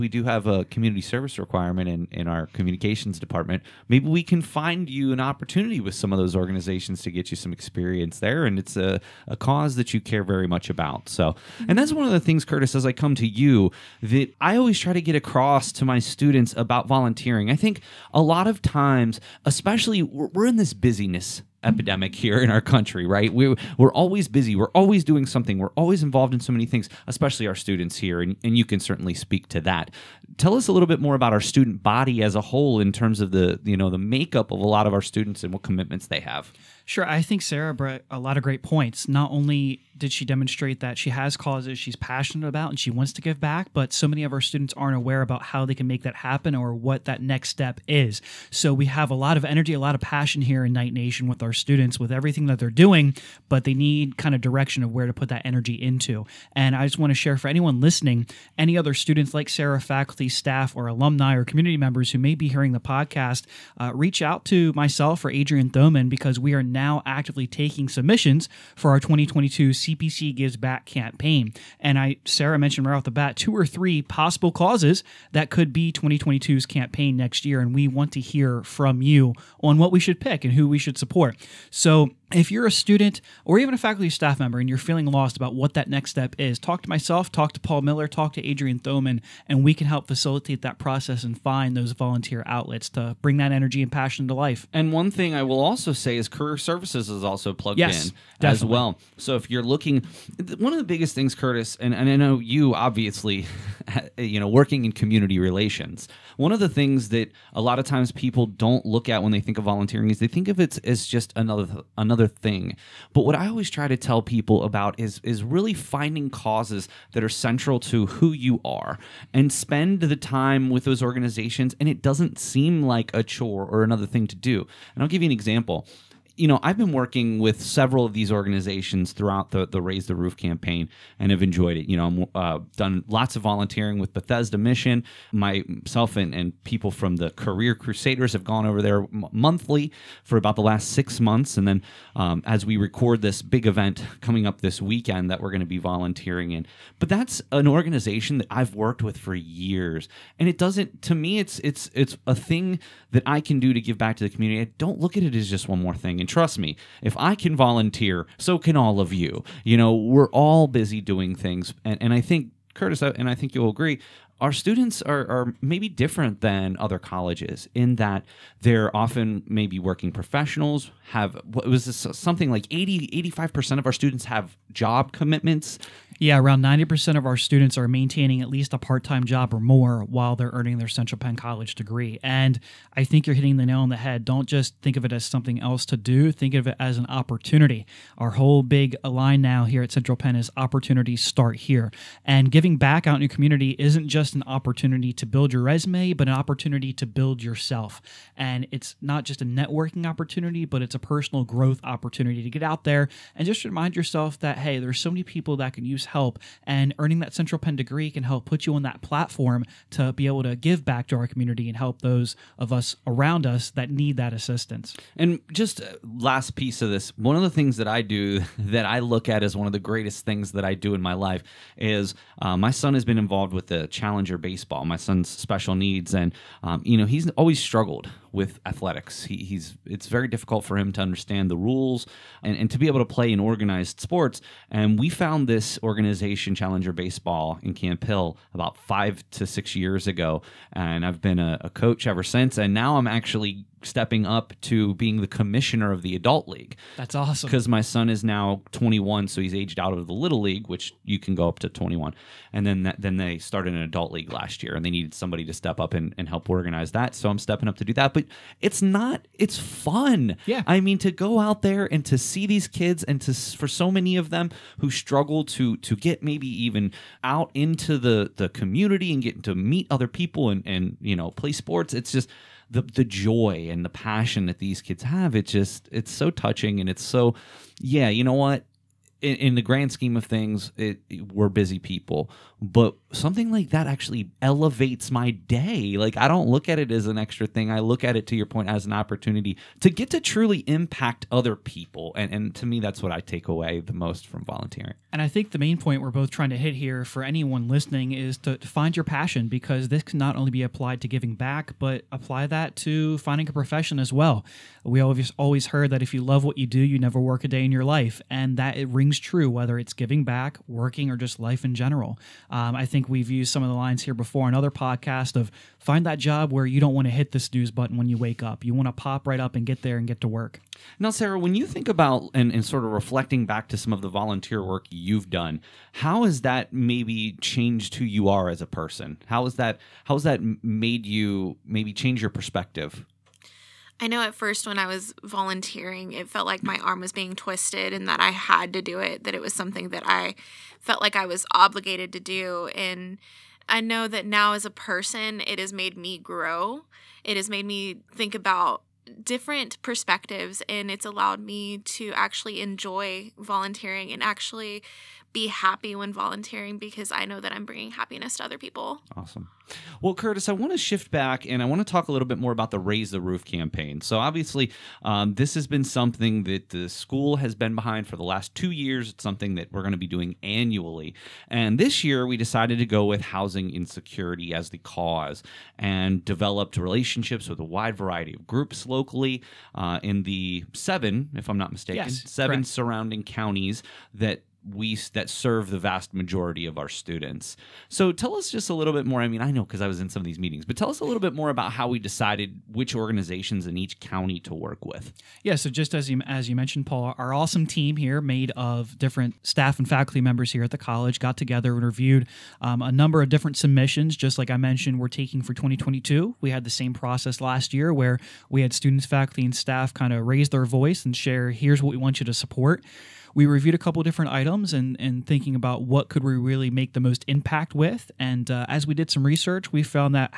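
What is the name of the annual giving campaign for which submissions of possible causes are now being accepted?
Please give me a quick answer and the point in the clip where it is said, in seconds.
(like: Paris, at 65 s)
CPC Gives Back, at 69 s.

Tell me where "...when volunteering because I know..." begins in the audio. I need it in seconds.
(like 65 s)
355 s.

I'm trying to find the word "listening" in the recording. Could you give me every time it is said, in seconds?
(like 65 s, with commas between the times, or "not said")
57 s, 297 s.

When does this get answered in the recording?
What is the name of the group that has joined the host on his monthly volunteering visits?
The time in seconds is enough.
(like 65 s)
137 s.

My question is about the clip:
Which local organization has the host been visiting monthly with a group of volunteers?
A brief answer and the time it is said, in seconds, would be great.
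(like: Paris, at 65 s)
Bethesda Mission, at 134 s.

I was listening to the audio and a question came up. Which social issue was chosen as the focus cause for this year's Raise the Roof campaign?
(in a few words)
Housing insecurity.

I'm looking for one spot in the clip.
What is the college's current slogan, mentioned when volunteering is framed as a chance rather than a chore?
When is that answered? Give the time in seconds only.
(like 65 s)
190 s.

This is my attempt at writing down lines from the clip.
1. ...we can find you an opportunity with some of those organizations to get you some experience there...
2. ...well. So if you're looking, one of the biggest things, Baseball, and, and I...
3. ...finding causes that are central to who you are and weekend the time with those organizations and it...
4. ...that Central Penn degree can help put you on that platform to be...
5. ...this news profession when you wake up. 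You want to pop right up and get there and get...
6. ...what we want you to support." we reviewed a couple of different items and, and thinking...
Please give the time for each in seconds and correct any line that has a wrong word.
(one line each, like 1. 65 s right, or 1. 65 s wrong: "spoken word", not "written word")
1. 4 s right
2. 98 s wrong: "Curtis", not "Baseball"
3. 115 s wrong: "spend", not "weekend"
4. 207 s right
5. 317 s wrong: "button", not "profession"
6. 411 s right.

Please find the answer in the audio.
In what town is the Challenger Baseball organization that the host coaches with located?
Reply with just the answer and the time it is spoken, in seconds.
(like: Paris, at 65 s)
Camp Hill, at 237 s.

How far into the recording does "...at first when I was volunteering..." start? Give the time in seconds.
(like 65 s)
334 s.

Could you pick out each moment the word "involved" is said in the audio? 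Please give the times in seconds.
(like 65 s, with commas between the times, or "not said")
26 s, 223 s.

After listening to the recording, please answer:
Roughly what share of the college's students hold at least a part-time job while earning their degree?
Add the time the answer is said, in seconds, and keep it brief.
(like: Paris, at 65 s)
90%, at 176 s.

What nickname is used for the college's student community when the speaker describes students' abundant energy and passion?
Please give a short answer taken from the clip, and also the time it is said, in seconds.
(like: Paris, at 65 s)
Knight Nation, at 50 s.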